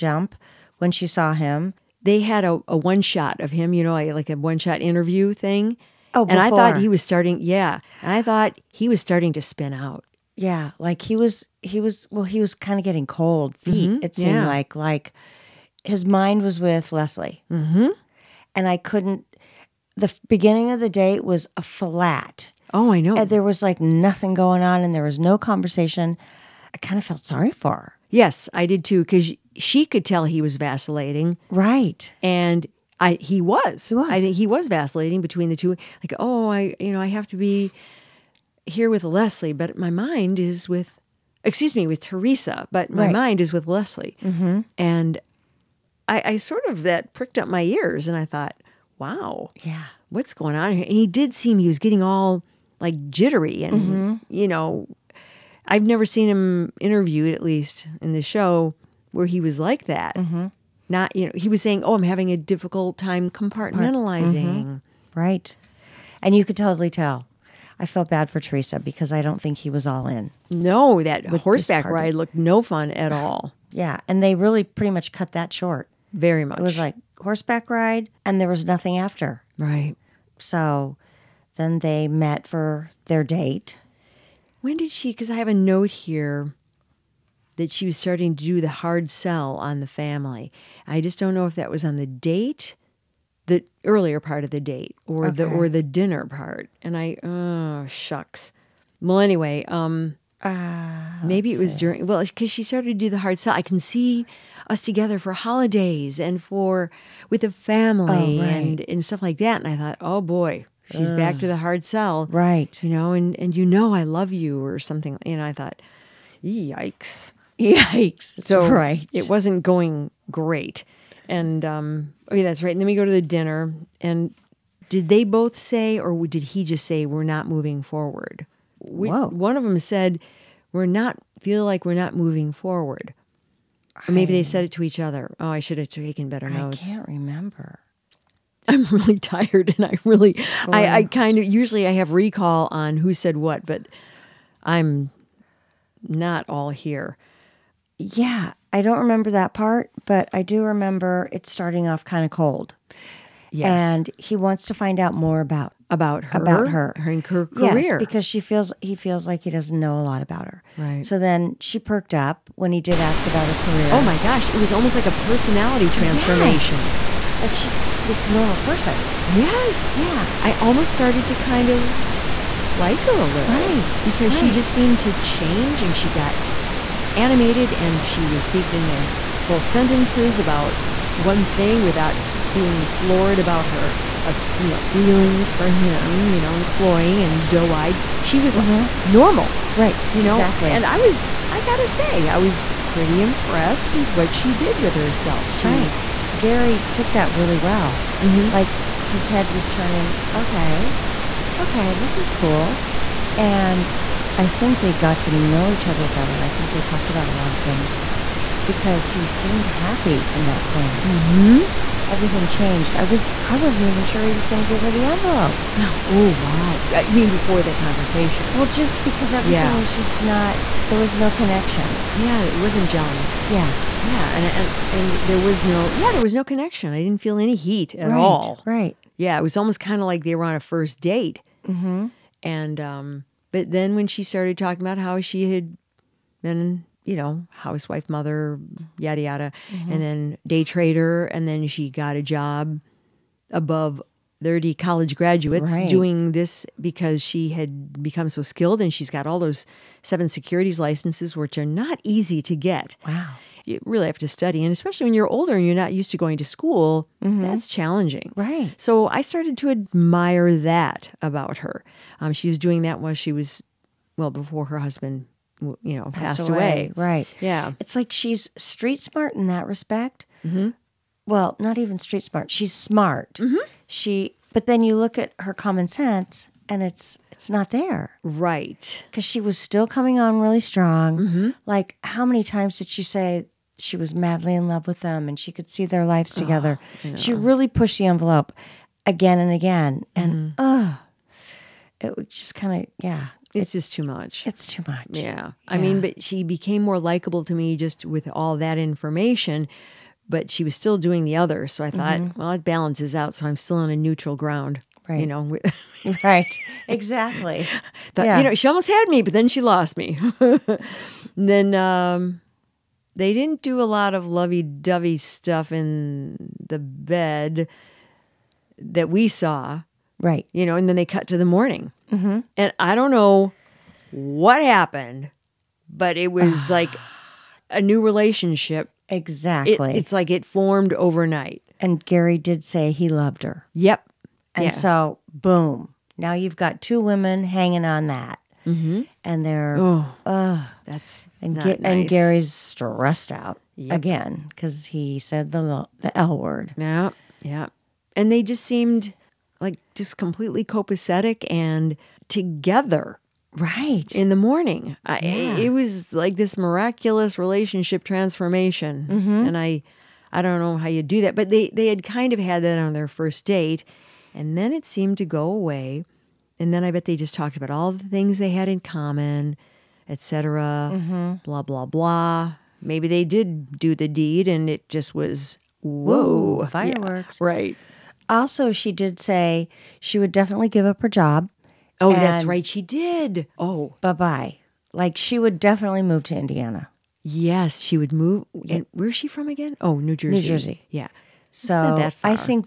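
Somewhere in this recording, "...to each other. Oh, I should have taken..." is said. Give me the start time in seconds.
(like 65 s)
134 s.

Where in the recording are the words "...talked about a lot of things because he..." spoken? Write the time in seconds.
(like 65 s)
206 s.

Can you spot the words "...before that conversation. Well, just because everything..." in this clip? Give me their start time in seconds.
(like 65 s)
217 s.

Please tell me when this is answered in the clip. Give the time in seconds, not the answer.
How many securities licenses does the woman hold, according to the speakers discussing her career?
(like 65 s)
250 s.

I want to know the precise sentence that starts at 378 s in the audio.
Also, she did say she would definitely give up her job.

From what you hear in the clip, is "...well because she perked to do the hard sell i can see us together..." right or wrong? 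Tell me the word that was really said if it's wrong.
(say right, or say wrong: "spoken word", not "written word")
wrong: "started", not "perked".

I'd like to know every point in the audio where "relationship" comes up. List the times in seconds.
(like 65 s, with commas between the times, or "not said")
328 s, 357 s.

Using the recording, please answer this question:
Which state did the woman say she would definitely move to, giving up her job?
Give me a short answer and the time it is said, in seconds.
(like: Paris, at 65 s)
Indiana, at 386 s.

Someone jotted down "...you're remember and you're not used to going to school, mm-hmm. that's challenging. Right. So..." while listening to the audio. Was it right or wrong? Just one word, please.
wrong.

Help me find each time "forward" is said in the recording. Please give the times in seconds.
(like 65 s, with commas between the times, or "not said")
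127 s, 132 s.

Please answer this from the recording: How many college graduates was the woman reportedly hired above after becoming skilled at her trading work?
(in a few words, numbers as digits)
30.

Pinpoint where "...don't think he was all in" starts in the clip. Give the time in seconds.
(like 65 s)
69 s.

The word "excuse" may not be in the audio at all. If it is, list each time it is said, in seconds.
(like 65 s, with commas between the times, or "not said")
41 s.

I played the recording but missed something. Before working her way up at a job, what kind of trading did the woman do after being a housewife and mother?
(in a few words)
Day trader.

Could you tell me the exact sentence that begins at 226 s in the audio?
I didn't feel any heat at right, all.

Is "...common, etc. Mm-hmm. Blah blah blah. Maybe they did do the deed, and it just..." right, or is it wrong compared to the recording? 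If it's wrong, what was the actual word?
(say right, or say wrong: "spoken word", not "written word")
right.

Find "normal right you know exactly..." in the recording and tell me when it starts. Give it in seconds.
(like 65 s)
189 s.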